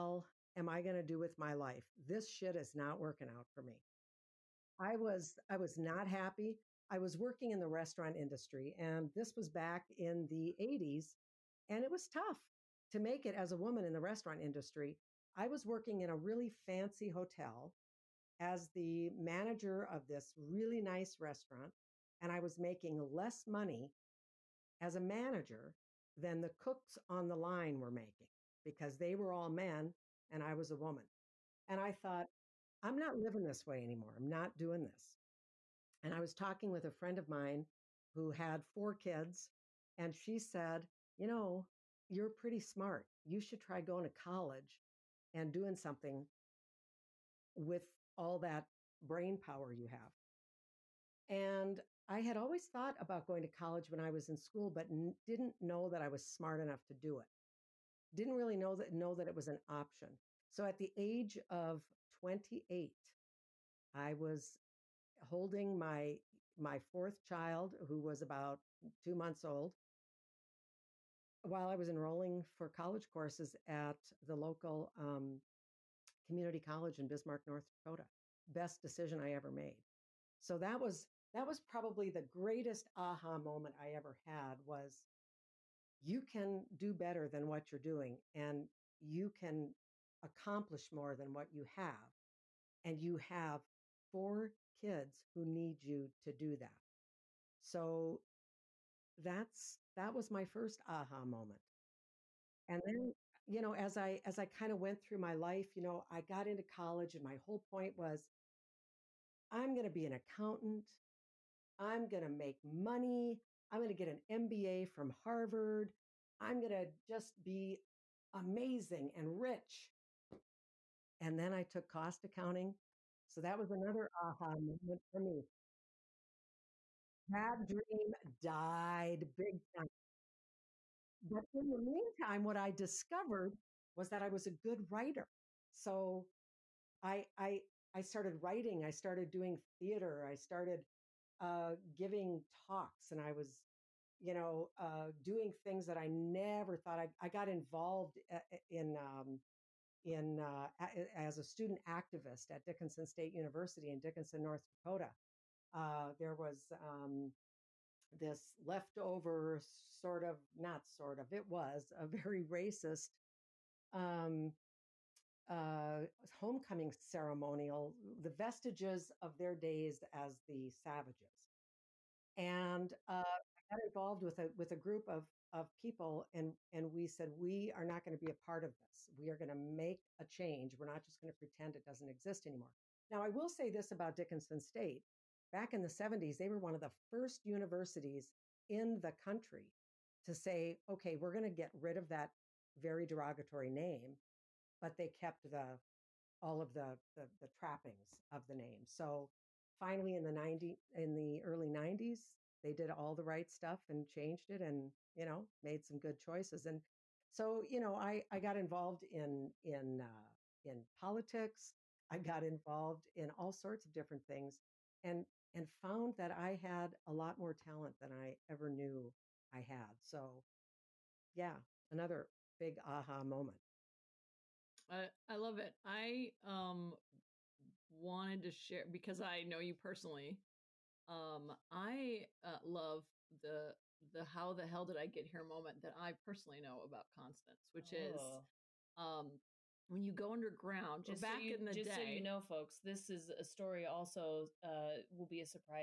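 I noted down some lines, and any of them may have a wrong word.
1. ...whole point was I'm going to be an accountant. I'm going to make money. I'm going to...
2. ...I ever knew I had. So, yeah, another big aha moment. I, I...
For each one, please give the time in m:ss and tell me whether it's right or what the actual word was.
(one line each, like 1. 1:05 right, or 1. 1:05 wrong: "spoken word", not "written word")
1. 1:47 right
2. 3:38 right.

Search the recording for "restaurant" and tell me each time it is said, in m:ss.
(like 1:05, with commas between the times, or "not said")
0:07, 0:14, 0:21.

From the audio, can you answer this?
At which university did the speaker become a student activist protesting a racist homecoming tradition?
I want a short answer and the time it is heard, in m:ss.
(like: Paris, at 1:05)
Dickinson State University, at 2:32.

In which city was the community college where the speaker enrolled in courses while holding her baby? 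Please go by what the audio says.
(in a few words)
Bismarck.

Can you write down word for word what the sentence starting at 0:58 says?
Didn't really know that know that it was an option.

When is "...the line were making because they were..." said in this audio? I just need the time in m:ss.
0:27.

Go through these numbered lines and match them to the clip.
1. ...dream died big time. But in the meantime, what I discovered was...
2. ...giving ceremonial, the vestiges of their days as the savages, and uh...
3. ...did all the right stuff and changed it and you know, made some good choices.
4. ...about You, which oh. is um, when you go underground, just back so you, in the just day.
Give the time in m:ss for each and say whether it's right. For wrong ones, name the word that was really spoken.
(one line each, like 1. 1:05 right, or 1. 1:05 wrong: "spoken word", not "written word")
1. 2:07 right
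2. 2:46 wrong: "homecoming", not "giving"
3. 3:22 right
4. 3:56 wrong: "Constance", not "You".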